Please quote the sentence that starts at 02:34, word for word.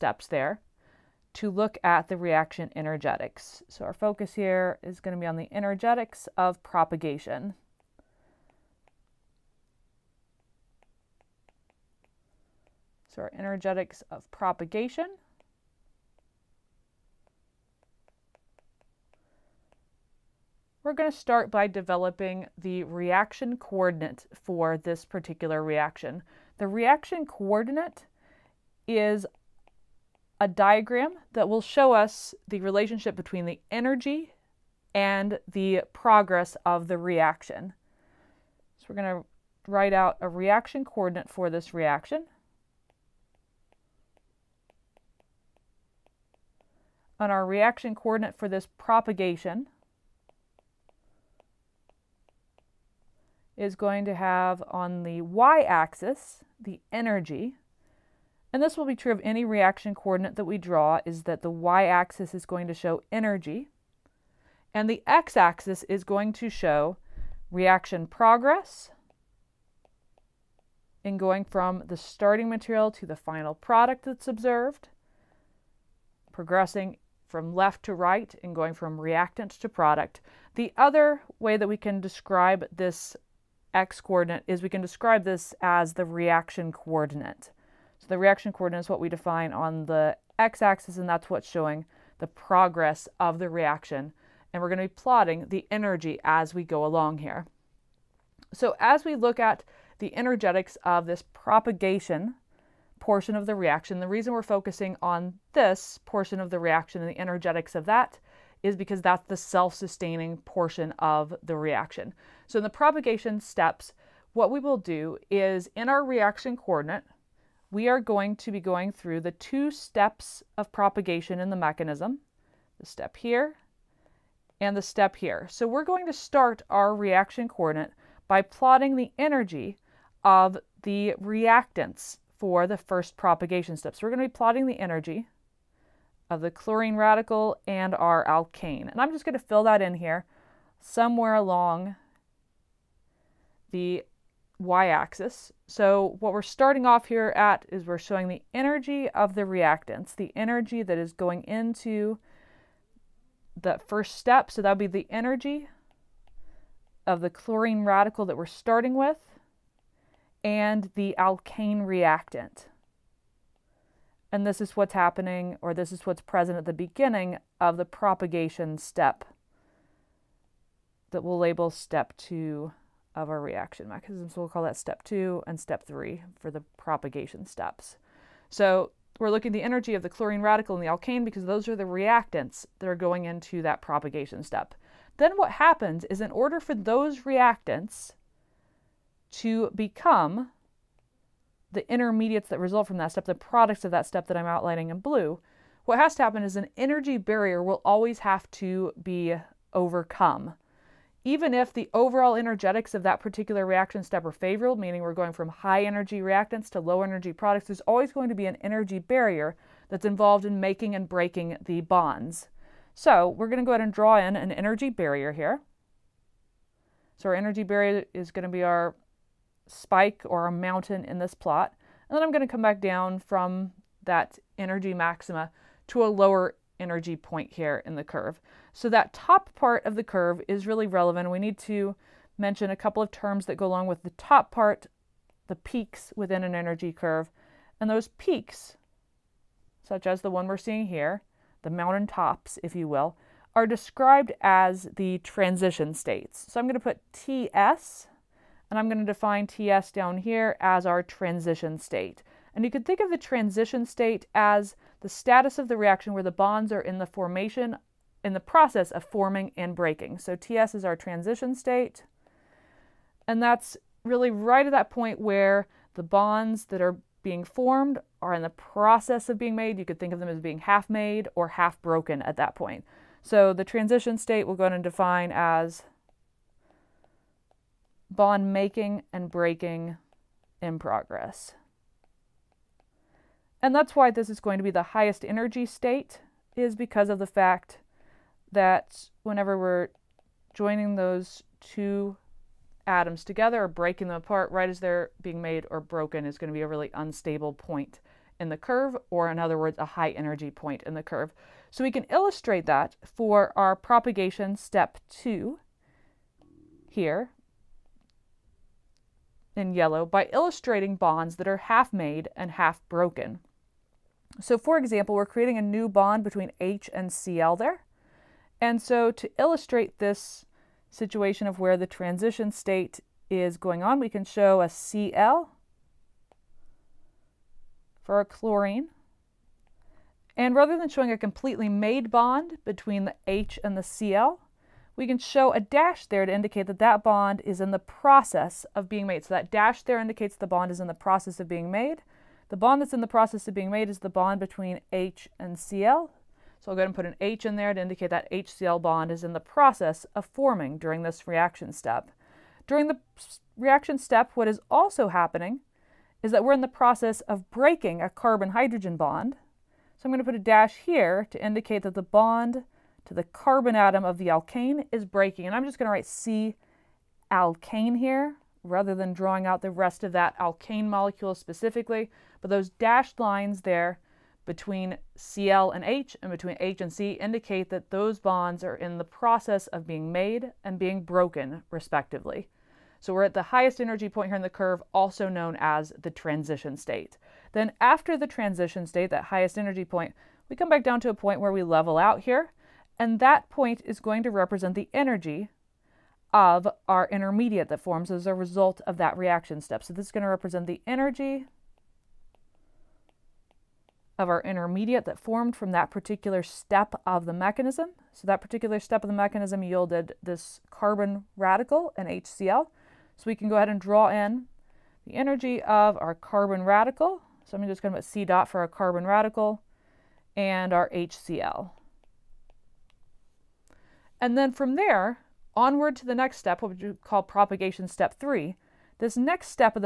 So that would be the energy of the chlorine radical that we're starting with and the alkane reactant.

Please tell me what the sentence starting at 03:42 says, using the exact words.
And then I'm going to come back down from that energy maxima to a lower energy point here in the curve.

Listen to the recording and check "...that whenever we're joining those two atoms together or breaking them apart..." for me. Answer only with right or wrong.
right.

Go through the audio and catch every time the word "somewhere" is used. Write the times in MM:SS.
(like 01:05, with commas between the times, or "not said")
02:20.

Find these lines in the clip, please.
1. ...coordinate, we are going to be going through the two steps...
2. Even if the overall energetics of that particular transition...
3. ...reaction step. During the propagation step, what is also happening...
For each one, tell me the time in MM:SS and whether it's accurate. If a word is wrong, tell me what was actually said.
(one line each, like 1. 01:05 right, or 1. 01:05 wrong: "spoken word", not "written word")
1. 01:56 right
2. 03:21 wrong: "reaction", not "transition"
3. 05:51 wrong: "reaction", not "propagation".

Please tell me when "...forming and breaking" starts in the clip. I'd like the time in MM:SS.
04:19.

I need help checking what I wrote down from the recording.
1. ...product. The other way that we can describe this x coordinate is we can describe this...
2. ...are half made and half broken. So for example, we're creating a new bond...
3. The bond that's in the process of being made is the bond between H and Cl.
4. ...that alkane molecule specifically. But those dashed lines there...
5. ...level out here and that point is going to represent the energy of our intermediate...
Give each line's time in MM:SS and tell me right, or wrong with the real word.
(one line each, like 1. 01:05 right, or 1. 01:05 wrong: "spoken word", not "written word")
1. 01:19 right
2. 05:11 right
3. 05:42 right
4. 06:10 right
5. 06:31 right.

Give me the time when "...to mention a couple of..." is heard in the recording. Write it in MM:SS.
03:51.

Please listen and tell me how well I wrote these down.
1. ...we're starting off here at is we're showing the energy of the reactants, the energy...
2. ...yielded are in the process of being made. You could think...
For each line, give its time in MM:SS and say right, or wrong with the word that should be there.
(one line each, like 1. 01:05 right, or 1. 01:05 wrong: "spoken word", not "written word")
1. 02:26 right
2. 04:27 wrong: "formed", not "yielded".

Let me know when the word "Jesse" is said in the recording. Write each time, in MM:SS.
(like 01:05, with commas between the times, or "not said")
not said.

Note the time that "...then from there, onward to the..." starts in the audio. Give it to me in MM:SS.
07:04.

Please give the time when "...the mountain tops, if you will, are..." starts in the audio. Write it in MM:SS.
04:01.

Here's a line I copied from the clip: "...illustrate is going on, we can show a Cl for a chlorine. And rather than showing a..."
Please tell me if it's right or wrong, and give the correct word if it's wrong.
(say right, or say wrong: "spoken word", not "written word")
wrong: "state", not "illustrate".